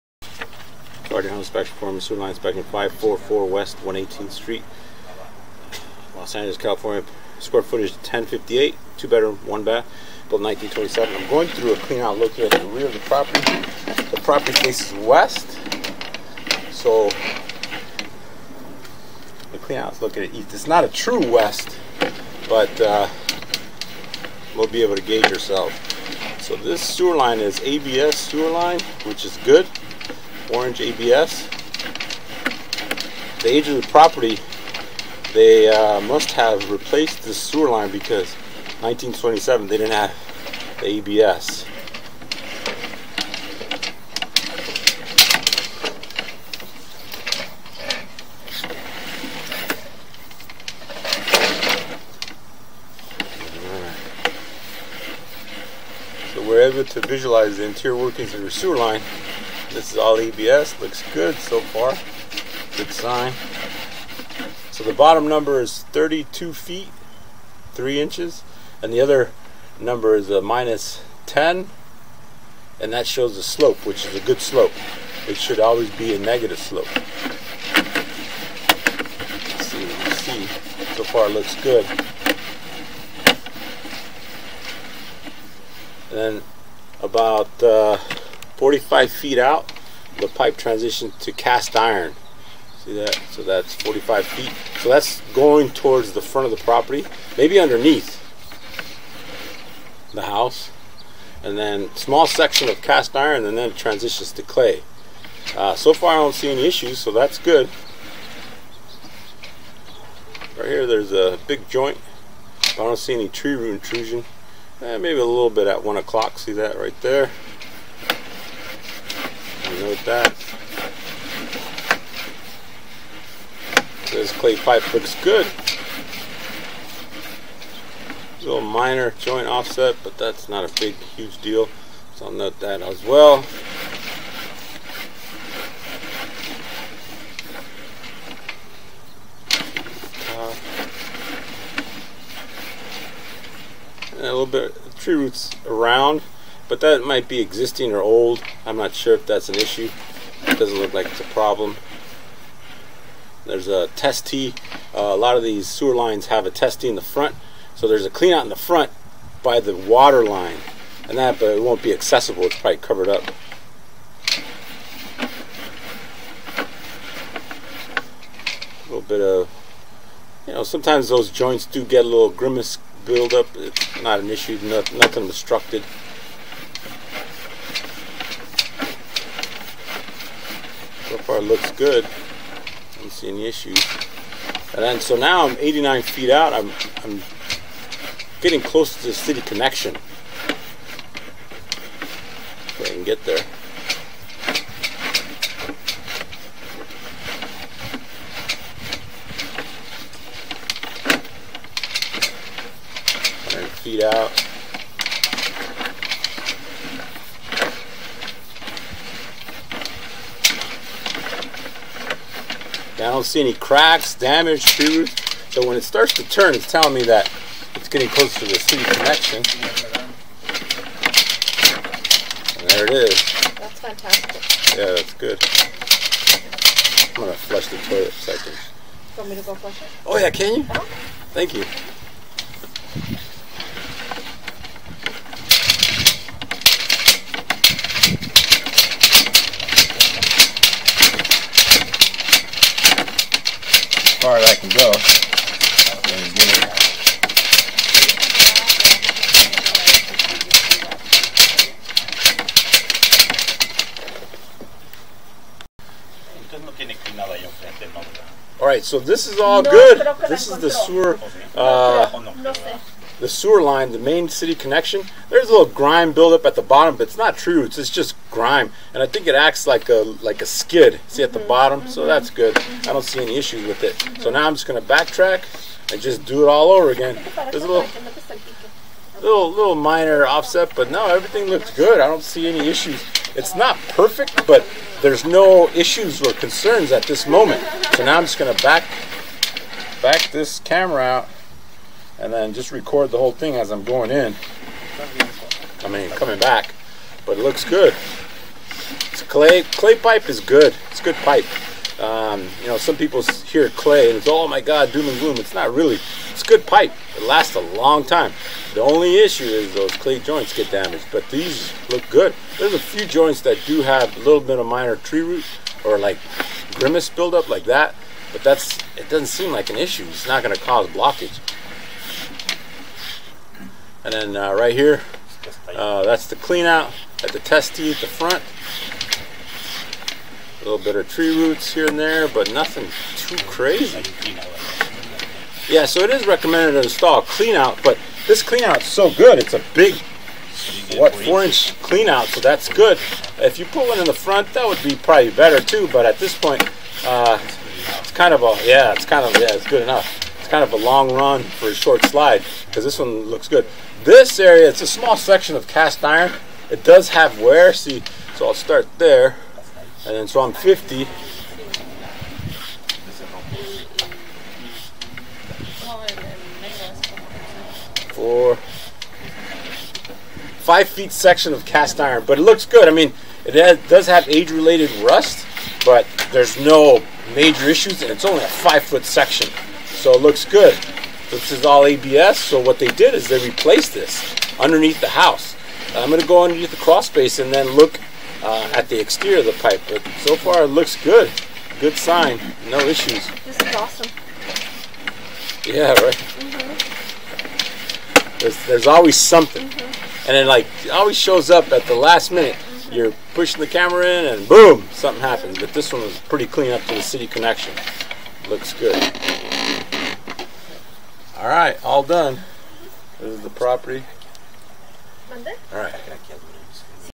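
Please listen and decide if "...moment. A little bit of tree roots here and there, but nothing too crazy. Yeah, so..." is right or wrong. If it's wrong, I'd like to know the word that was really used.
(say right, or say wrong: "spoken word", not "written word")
wrong: "front", not "moment".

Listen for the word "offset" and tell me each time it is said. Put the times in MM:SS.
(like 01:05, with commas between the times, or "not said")
02:09, 04:40.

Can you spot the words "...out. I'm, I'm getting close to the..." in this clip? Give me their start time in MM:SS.
03:06.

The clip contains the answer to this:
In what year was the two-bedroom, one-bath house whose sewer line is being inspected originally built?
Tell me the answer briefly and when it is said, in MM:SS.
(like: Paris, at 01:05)
1927, at 00:10.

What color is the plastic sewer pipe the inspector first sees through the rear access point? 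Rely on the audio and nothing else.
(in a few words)
Orange.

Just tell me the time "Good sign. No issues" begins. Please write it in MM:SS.
06:31.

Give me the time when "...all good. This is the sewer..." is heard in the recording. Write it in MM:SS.
04:19.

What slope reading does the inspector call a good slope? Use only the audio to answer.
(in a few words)
-10.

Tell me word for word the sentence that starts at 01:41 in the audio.
And then small section of cast iron and then it transitions to clay.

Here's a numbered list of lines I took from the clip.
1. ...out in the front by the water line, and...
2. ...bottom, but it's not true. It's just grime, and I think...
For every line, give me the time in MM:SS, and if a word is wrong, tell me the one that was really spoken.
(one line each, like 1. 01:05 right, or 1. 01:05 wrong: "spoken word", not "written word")
1. 02:38 right
2. 04:26 right.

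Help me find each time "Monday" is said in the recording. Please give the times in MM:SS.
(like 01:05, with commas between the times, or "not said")
06:55.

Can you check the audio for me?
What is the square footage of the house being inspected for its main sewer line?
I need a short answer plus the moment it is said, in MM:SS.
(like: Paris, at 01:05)
1058, at 00:07.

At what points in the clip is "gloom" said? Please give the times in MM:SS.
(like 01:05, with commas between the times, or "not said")
05:05.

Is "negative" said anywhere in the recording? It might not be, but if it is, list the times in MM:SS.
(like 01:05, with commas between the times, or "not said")
01:16.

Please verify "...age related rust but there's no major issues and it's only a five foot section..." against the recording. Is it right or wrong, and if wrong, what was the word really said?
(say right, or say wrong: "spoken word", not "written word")
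right.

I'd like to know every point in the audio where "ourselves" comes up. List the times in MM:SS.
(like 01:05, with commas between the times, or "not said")
00:25.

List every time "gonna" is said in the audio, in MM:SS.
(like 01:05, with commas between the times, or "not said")
03:47, 04:34, 04:48, 06:26.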